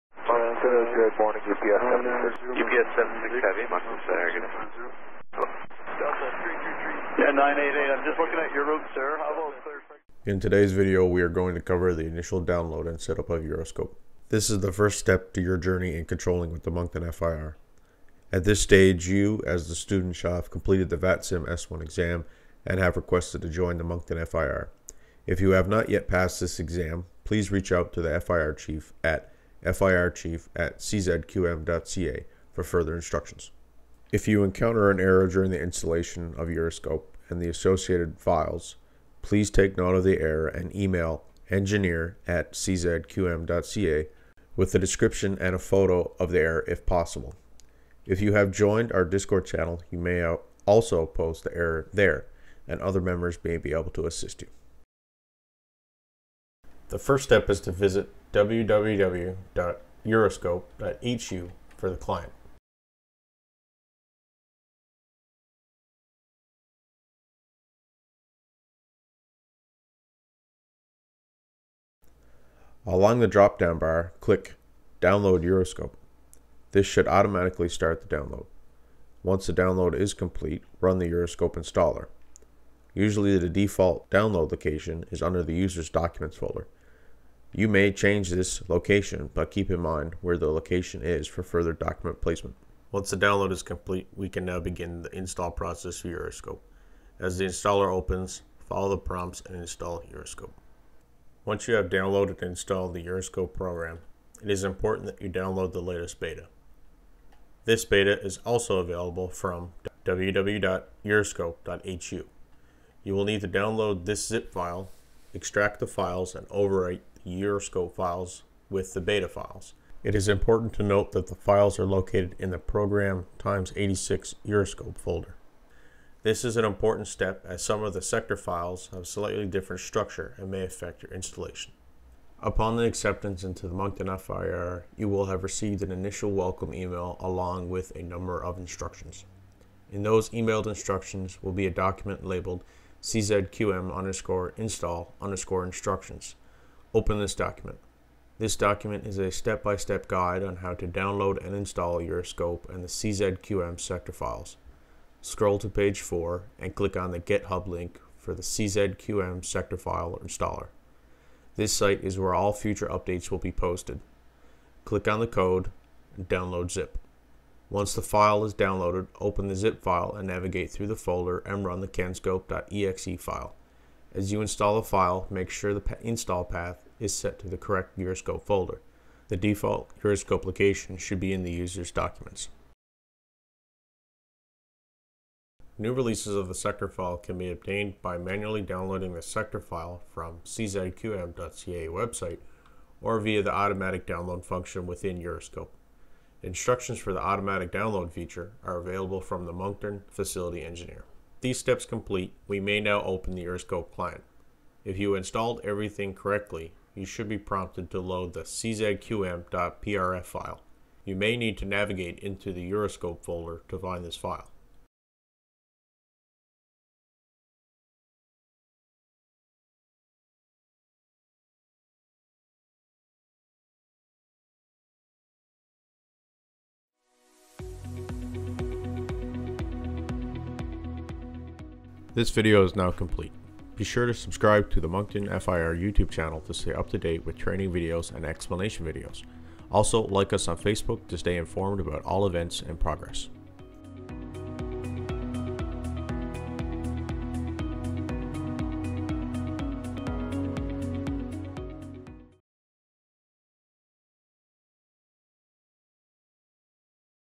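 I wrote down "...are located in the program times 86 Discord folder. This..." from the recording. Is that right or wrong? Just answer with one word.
wrong.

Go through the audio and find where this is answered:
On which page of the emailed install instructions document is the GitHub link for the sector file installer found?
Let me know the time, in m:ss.
2:35.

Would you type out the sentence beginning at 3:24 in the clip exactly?
If you installed everything correctly, you should be prompted to load the czqm.prf file.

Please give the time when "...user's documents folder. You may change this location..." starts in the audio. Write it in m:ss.
1:25.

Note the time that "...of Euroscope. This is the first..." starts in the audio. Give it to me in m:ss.
0:13.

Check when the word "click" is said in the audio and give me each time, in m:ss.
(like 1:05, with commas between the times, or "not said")
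1:14, 2:36, 2:44.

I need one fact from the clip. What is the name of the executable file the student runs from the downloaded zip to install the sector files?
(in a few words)
canscope.exe.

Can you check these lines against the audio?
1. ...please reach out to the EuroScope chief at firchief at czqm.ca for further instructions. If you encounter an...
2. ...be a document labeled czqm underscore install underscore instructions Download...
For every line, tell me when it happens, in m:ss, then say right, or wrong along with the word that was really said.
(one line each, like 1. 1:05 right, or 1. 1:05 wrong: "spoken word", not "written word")
1. 0:27 wrong: "FIR", not "EuroScope"
2. 2:21 wrong: "Open", not "Download".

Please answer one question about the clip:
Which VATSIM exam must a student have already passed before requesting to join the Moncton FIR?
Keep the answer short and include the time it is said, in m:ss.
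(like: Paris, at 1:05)
S1 exam, at 0:21.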